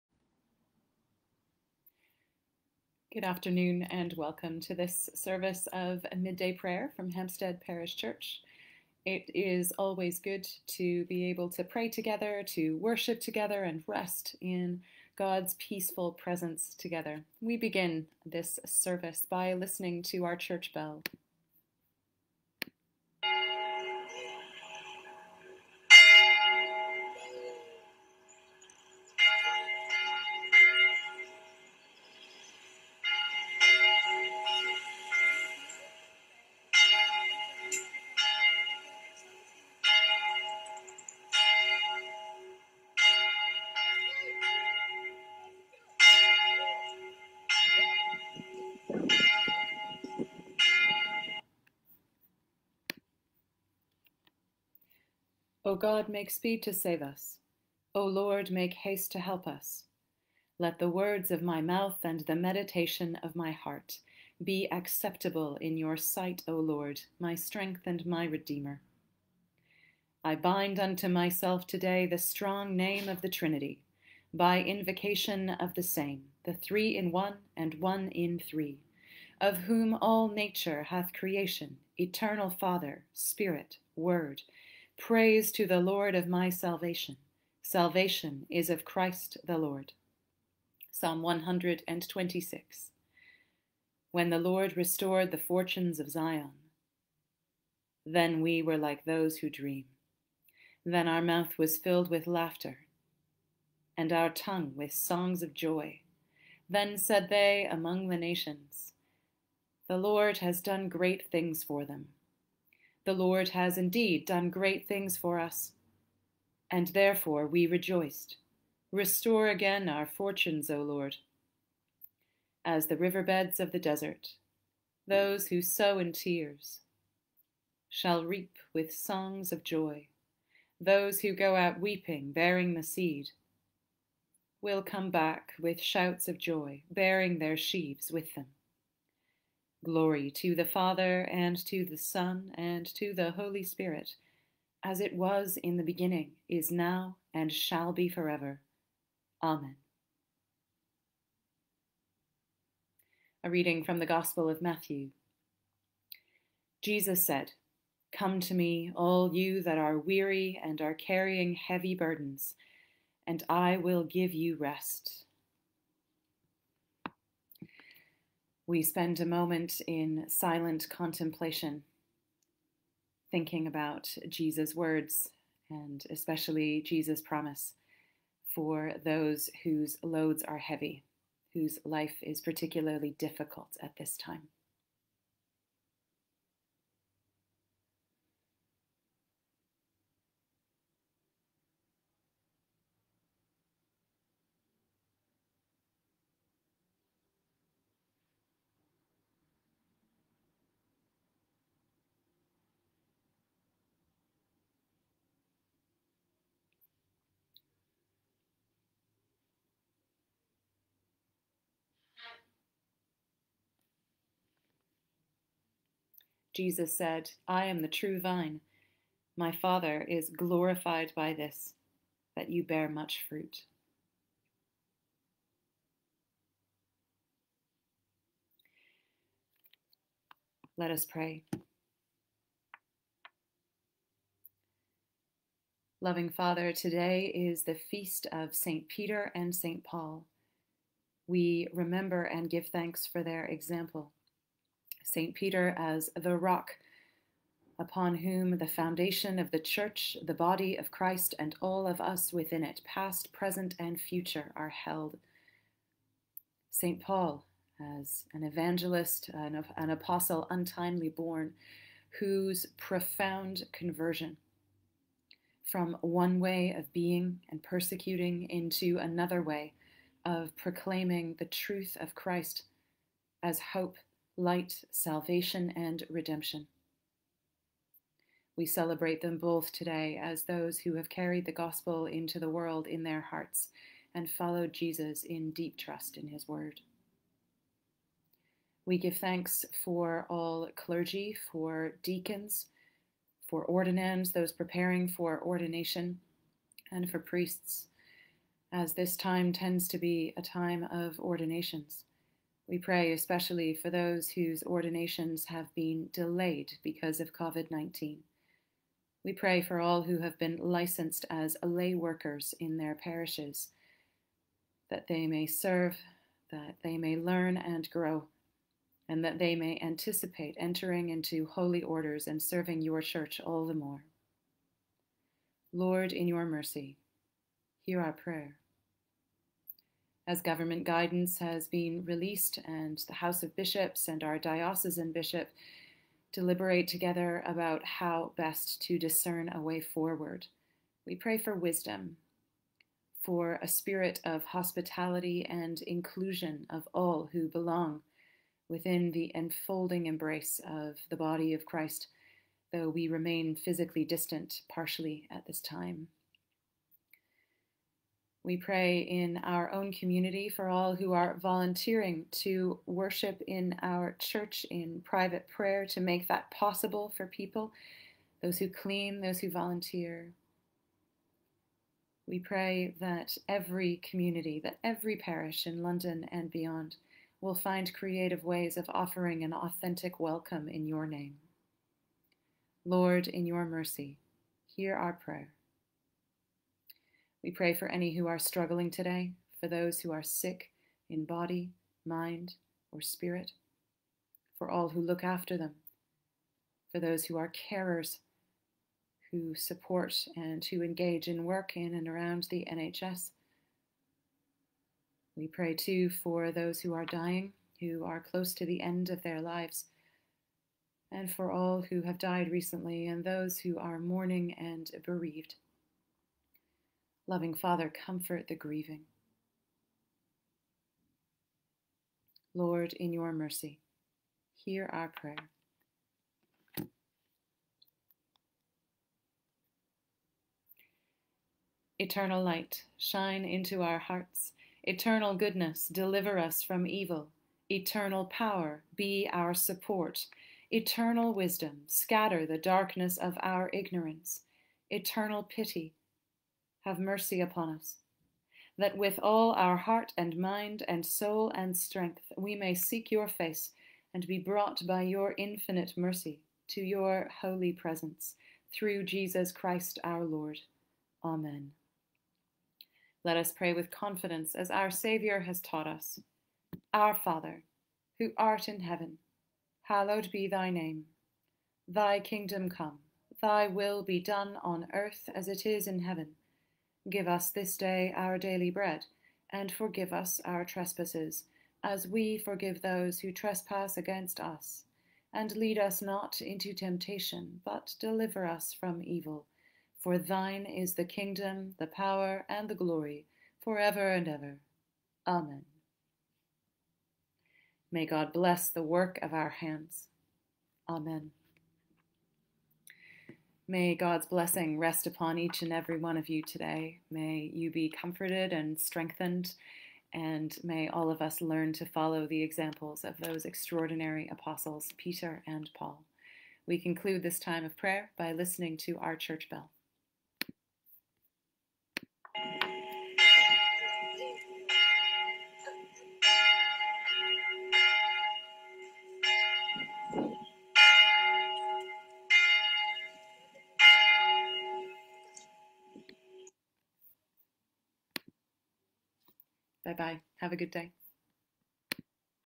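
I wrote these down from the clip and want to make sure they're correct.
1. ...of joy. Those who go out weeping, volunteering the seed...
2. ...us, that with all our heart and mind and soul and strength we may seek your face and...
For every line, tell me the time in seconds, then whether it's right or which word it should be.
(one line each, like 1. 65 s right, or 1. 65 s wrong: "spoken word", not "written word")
1. 129 s wrong: "bearing", not "volunteering"
2. 447 s right.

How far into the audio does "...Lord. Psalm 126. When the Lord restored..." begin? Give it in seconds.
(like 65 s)
89 s.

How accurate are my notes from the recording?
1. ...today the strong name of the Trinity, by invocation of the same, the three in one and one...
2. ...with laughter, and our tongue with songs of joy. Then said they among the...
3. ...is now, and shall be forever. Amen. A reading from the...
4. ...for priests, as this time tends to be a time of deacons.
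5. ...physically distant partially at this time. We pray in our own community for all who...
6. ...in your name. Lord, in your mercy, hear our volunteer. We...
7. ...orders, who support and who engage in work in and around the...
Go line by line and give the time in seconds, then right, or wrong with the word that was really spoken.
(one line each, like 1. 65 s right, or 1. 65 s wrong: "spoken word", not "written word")
1. 71 s right
2. 102 s right
3. 146 s right
4. 297 s wrong: "ordinations", not "deacons"
5. 353 s right
6. 380 s wrong: "prayer", not "volunteer"
7. 397 s wrong: "carers", not "orders".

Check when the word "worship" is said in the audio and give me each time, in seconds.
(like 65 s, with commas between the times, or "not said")
12 s, 362 s.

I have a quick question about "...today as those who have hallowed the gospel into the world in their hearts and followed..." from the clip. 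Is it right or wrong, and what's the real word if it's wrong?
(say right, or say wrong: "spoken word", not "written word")
wrong: "carried", not "hallowed".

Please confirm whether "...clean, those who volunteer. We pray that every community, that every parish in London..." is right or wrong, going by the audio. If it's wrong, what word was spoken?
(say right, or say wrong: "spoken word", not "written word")
right.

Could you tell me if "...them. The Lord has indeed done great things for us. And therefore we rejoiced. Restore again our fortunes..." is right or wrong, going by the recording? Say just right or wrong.
right.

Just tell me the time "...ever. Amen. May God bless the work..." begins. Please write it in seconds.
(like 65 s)
494 s.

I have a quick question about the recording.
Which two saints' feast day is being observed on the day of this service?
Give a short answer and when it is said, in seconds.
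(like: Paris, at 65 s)
St. Peter and St. Paul, at 238 s.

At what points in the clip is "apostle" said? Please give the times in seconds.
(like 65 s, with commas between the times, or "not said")
259 s, 514 s.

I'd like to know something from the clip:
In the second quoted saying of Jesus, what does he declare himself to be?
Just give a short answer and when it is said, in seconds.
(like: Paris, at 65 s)
the true vine, at 217 s.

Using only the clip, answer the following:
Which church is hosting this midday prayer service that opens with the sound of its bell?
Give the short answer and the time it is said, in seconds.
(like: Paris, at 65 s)
Hampstead Parish Church, at 7 s.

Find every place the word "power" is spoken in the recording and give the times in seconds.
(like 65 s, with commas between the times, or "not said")
438 s, 491 s.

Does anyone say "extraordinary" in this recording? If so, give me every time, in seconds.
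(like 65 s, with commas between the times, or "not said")
513 s.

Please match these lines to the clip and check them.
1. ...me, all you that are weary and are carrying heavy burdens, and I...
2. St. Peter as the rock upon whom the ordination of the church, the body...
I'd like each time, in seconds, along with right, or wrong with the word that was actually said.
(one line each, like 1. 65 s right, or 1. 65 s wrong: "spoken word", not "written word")
1. 158 s right
2. 245 s wrong: "foundation", not "ordination".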